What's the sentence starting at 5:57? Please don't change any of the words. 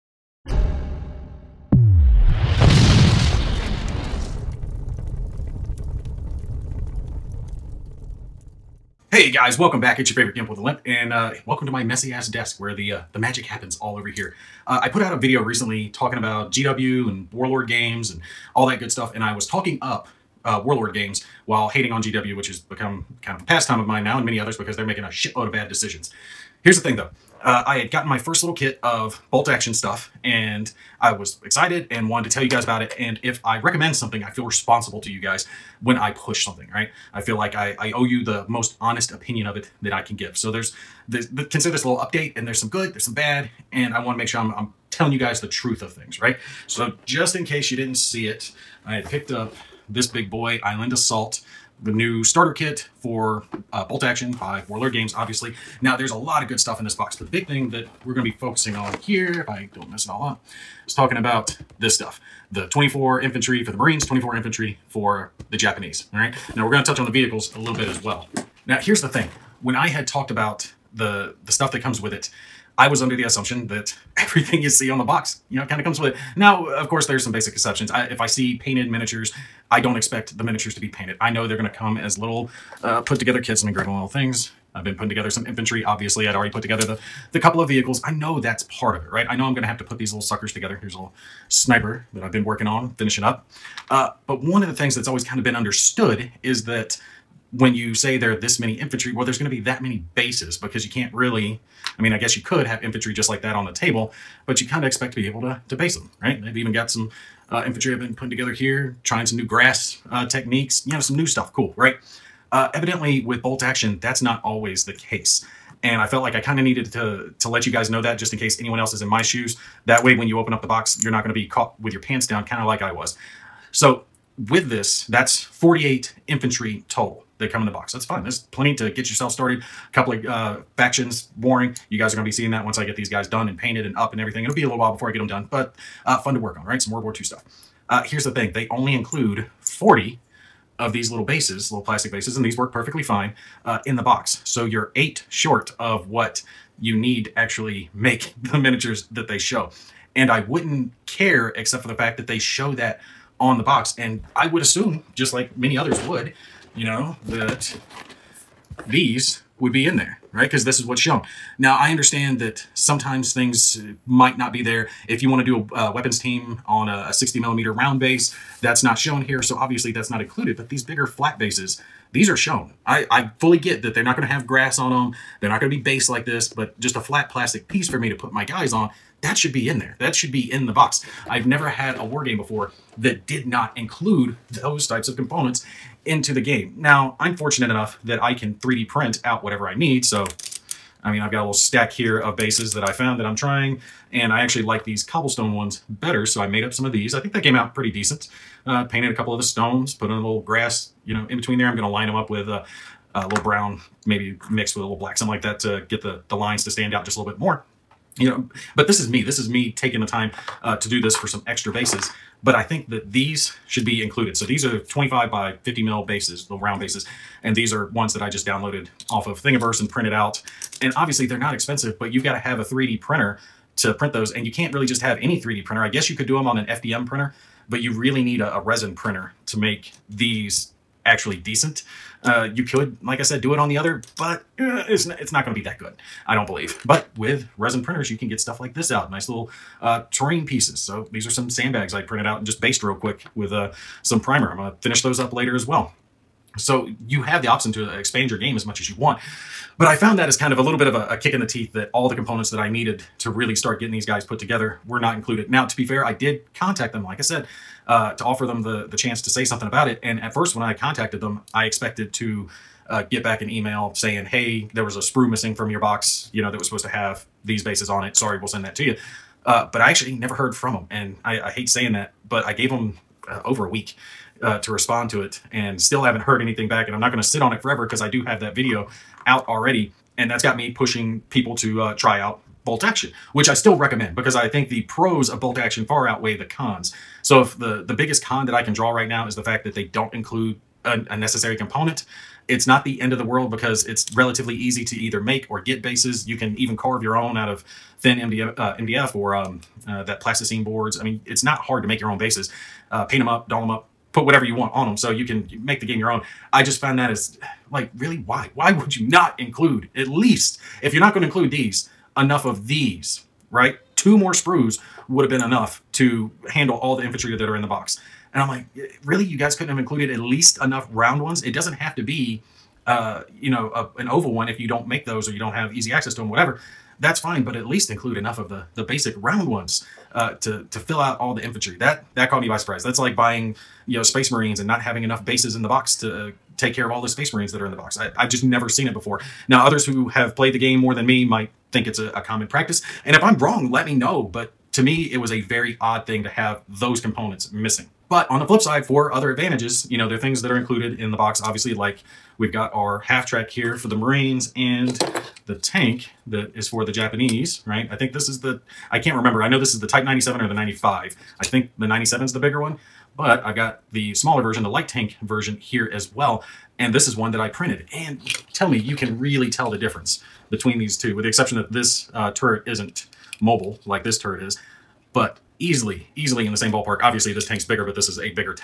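I think this is the, I can't remember.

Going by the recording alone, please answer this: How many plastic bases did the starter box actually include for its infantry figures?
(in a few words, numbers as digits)
40.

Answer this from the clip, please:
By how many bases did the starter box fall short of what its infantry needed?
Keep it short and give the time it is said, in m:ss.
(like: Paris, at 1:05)
eight, at 2:24.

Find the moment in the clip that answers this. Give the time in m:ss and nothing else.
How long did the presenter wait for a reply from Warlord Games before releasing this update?
4:33.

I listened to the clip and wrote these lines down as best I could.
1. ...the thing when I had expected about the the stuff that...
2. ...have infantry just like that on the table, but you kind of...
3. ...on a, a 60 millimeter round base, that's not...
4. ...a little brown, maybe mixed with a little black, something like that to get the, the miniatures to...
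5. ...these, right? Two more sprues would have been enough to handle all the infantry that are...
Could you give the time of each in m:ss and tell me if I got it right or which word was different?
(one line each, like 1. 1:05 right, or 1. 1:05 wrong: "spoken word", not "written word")
1. 1:09 wrong: "talked", not "expected"
2. 1:42 right
3. 2:46 right
4. 3:23 wrong: "lines", not "miniatures"
5. 5:12 right.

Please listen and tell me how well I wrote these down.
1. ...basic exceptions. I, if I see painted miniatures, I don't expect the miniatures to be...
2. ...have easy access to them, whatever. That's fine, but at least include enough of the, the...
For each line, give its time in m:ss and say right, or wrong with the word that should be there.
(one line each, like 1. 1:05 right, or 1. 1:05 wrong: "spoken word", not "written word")
1. 1:17 right
2. 5:25 right.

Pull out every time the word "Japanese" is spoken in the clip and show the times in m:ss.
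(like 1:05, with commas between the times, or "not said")
1:05, 5:56.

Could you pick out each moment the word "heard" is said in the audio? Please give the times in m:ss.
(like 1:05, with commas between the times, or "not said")
4:30, 4:36.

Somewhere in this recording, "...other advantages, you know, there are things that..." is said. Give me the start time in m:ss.
5:49.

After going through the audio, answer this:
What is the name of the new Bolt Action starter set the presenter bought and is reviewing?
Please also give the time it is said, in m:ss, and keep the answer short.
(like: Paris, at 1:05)
Island Assault, at 0:50.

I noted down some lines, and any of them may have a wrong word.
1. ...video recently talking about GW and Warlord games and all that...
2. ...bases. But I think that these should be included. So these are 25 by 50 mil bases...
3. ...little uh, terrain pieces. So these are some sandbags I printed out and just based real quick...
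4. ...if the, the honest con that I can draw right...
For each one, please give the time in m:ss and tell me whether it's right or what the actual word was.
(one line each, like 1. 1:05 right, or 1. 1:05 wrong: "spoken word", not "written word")
1. 0:15 right
2. 3:31 right
3. 3:59 right
4. 4:47 wrong: "biggest", not "honest".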